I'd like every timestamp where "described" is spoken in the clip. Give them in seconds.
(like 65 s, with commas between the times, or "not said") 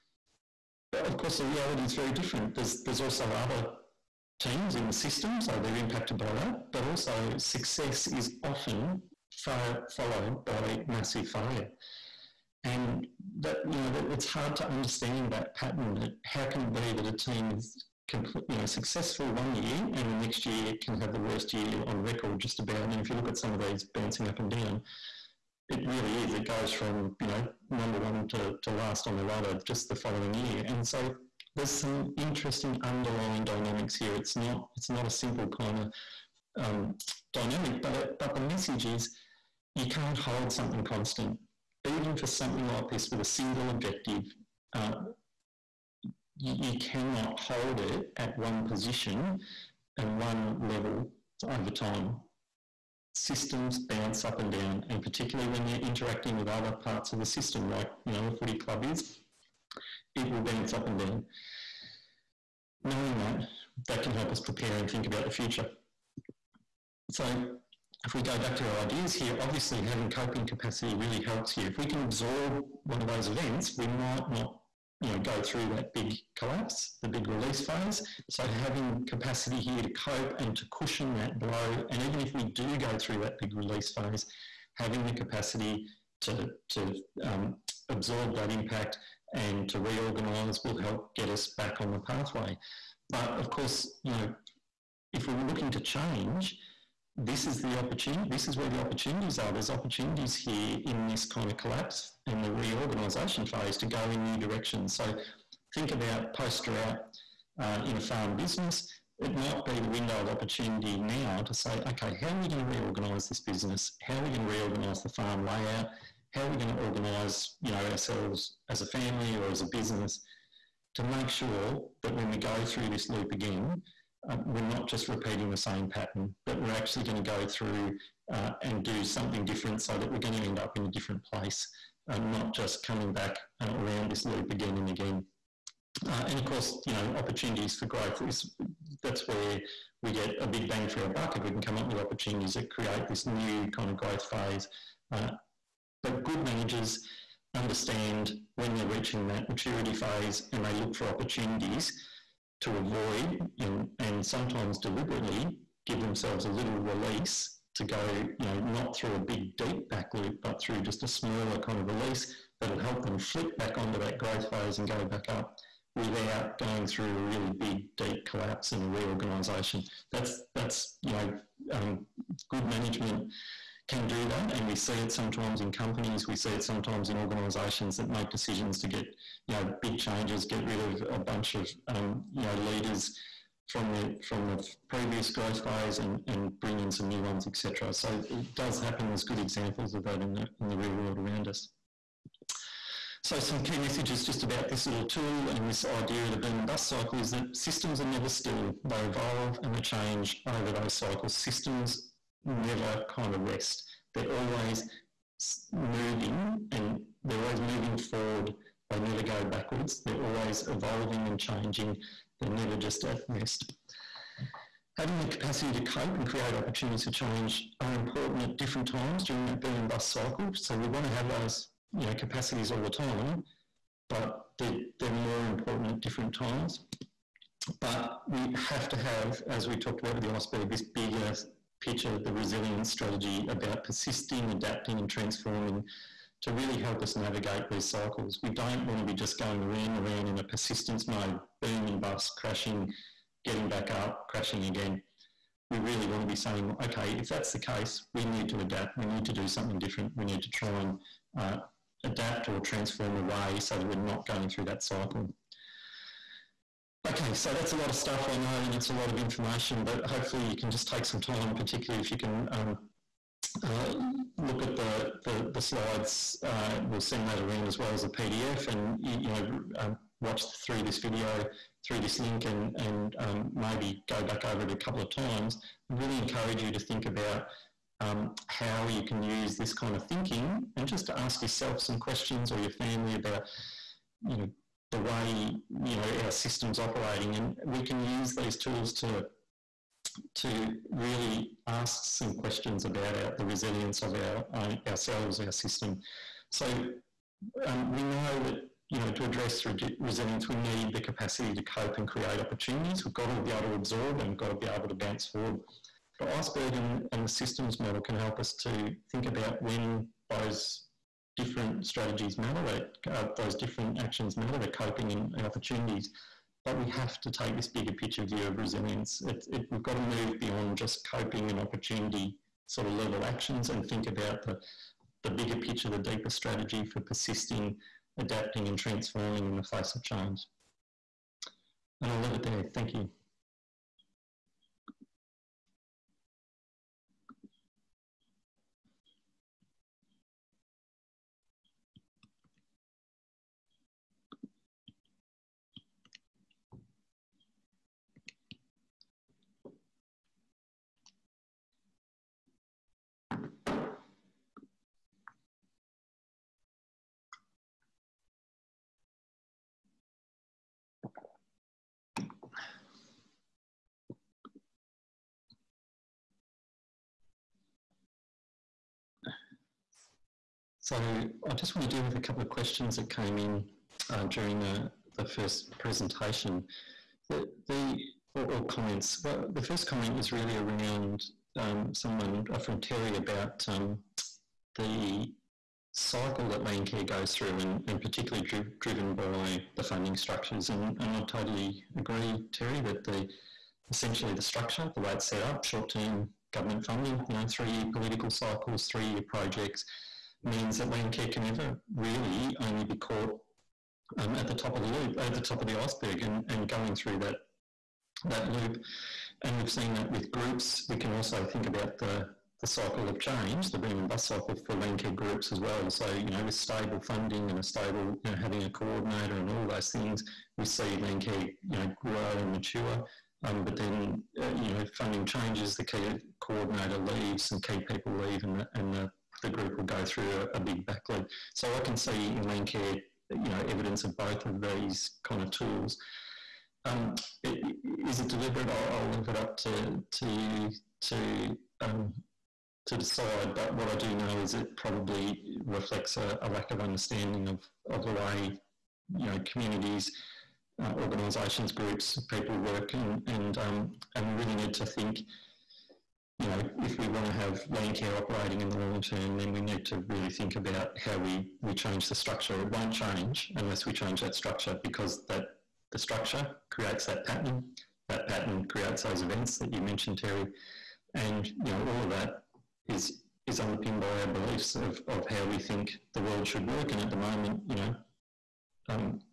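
not said.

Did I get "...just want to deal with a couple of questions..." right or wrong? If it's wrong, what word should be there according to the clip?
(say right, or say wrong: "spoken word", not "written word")
right.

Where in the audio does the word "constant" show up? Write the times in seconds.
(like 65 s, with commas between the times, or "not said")
40 s.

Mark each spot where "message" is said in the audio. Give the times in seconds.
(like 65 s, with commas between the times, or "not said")
38 s, 193 s.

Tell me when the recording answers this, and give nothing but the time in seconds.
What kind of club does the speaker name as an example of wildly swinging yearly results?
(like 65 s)
58 s.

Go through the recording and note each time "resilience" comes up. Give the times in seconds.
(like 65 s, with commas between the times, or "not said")
232 s, 293 s, 300 s, 318 s.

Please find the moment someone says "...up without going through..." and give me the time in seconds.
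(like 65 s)
165 s.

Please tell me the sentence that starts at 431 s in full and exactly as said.
So I can see in Landcare, you know, evidence of both of these kind of tools.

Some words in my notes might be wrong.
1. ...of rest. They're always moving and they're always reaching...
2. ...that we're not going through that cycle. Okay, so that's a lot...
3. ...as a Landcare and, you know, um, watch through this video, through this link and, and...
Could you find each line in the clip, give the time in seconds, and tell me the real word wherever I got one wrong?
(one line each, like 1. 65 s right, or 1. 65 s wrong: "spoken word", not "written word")
1. 203 s wrong: "moving", not "reaching"
2. 253 s right
3. 267 s wrong: "PDF", not "Landcare".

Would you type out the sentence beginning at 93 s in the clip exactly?
But of course, you know, if we were looking to change, this is the opportunity, this is where the opportunities are.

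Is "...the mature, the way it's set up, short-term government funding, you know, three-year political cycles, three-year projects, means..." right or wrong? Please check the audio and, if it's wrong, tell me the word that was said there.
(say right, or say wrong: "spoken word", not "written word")
wrong: "structure", not "mature".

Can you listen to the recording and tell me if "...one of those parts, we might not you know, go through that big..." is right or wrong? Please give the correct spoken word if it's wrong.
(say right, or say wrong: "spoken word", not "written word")
wrong: "events", not "parts".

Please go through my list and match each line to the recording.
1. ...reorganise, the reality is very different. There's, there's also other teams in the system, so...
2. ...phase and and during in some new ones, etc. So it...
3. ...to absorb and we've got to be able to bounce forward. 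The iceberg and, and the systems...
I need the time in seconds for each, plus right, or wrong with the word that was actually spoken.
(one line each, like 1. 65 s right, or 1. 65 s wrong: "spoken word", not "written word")
1. 1 s wrong: "course", not "reorganise"
2. 185 s wrong: "bring", not "during"
3. 303 s right.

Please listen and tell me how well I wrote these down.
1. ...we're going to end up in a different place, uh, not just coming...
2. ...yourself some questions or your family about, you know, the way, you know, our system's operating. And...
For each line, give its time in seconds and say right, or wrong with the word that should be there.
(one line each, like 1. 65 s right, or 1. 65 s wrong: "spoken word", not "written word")
1. 130 s right
2. 281 s right.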